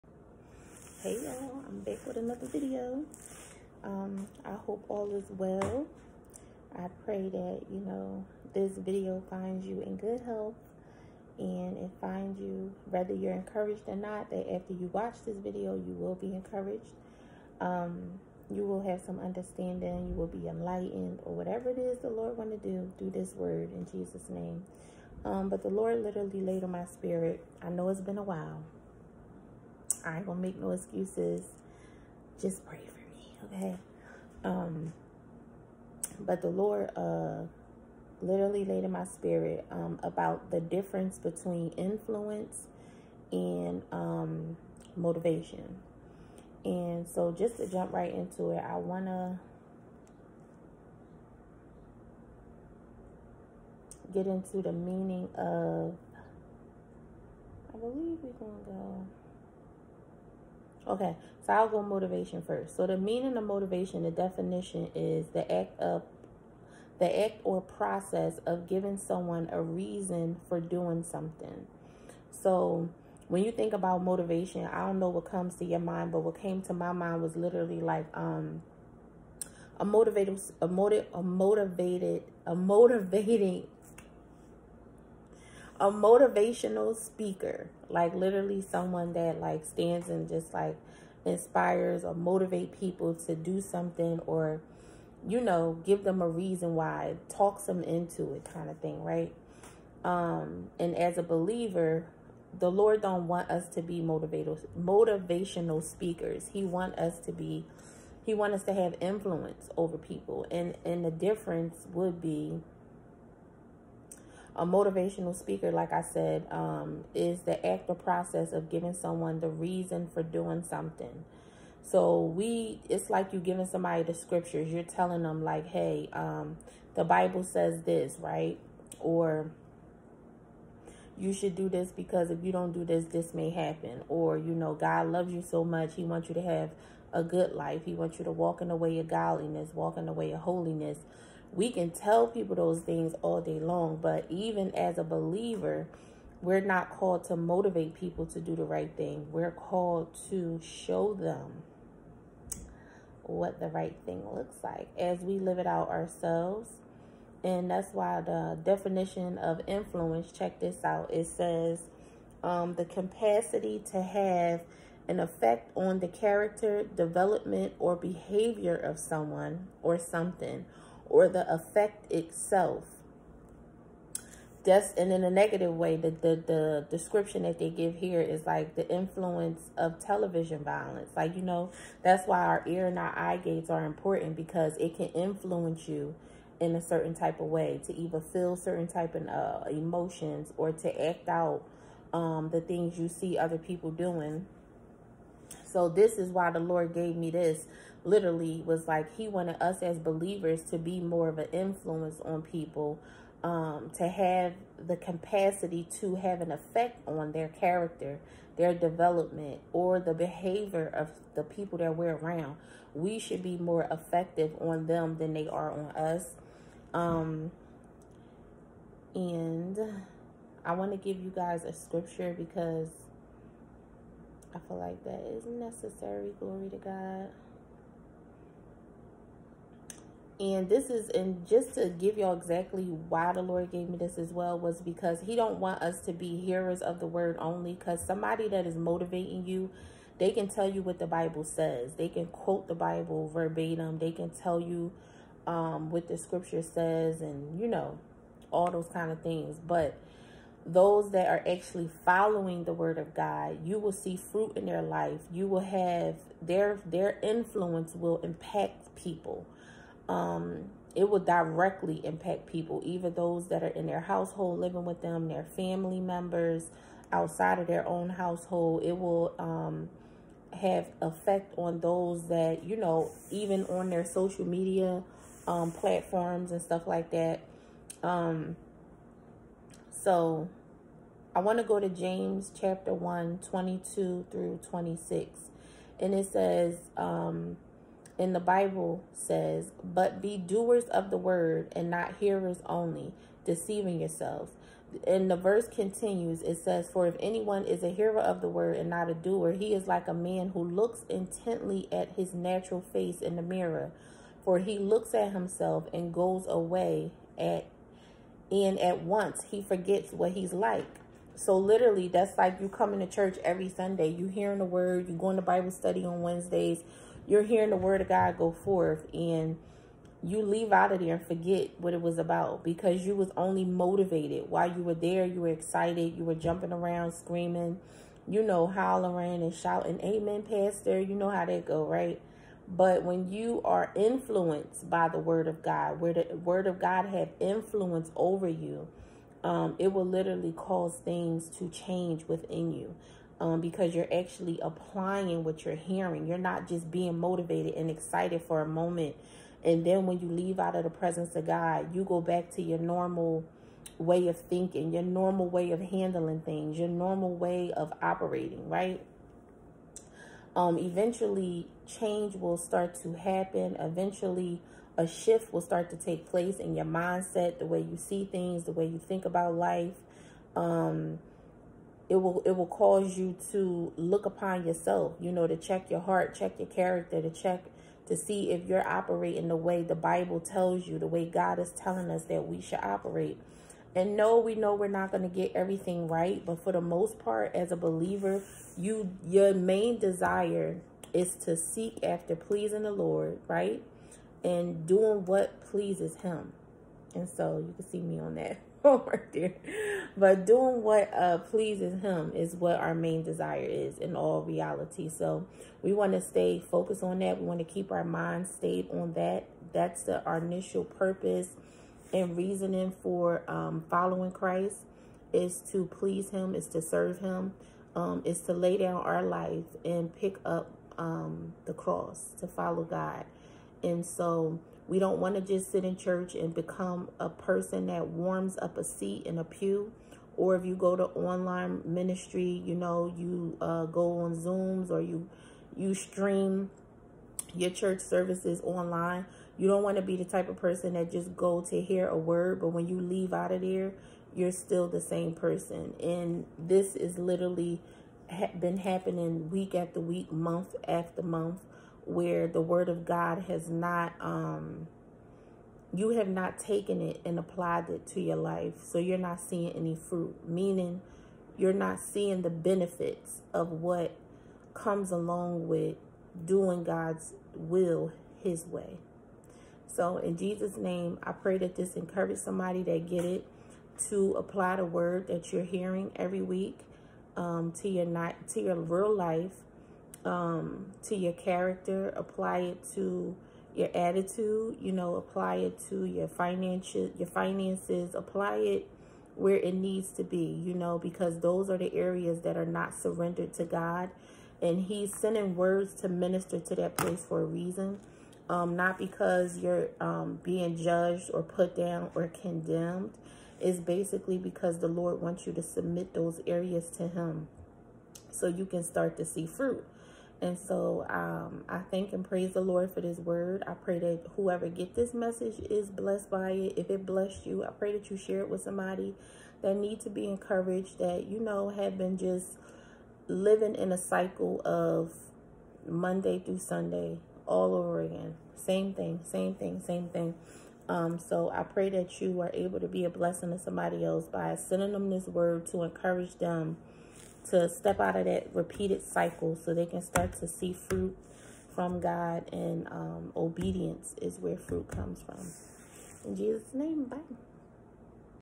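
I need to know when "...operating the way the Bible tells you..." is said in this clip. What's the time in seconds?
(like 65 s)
378 s.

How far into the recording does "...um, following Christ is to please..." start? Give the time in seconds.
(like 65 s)
413 s.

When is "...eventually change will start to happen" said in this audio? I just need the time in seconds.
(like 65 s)
360 s.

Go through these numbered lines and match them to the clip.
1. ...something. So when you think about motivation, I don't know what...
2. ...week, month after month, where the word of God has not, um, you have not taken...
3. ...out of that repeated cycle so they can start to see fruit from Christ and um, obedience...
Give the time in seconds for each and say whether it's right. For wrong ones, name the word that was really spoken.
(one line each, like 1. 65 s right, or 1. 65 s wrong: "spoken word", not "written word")
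1. 71 s right
2. 449 s right
3. 537 s wrong: "God", not "Christ".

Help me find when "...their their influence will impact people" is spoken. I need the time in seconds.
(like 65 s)
256 s.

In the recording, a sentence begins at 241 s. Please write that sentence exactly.
They can quote the Bible verbatim.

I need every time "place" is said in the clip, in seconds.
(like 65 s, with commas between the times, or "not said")
366 s, 496 s.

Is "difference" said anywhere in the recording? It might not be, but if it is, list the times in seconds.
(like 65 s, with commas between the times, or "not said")
40 s, 111 s.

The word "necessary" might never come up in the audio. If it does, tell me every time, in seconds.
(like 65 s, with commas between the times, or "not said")
225 s.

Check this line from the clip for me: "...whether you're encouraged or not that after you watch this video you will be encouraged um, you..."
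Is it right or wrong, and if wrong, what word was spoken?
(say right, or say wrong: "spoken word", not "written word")
right.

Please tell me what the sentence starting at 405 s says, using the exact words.
So we want to stay focused on that.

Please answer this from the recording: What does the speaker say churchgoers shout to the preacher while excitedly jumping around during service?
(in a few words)
Amen, Pastor.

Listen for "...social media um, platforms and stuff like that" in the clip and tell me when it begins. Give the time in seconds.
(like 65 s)
274 s.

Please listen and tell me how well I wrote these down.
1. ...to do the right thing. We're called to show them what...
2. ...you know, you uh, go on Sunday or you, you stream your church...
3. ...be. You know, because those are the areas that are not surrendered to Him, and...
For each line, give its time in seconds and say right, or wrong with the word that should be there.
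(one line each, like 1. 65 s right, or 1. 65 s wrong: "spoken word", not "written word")
1. 148 s right
2. 432 s wrong: "Zooms", not "Sunday"
3. 490 s wrong: "God", not "Him".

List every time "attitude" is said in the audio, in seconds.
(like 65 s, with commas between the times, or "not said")
483 s.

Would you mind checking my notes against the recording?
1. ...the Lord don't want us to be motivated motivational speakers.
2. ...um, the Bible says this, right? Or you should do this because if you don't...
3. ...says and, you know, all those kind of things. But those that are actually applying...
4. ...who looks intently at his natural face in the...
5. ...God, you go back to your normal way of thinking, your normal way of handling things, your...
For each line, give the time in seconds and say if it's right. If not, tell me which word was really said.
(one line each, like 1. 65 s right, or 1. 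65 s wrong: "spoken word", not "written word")
1. 102 s right
2. 126 s right
3. 246 s wrong: "following", not "applying"
4. 300 s right
5. 351 s right.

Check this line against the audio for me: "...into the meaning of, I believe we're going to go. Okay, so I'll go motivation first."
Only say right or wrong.
right.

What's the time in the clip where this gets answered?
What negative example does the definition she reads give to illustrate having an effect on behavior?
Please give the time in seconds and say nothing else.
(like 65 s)
179 s.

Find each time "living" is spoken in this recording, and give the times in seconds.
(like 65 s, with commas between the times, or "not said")
264 s, 523 s.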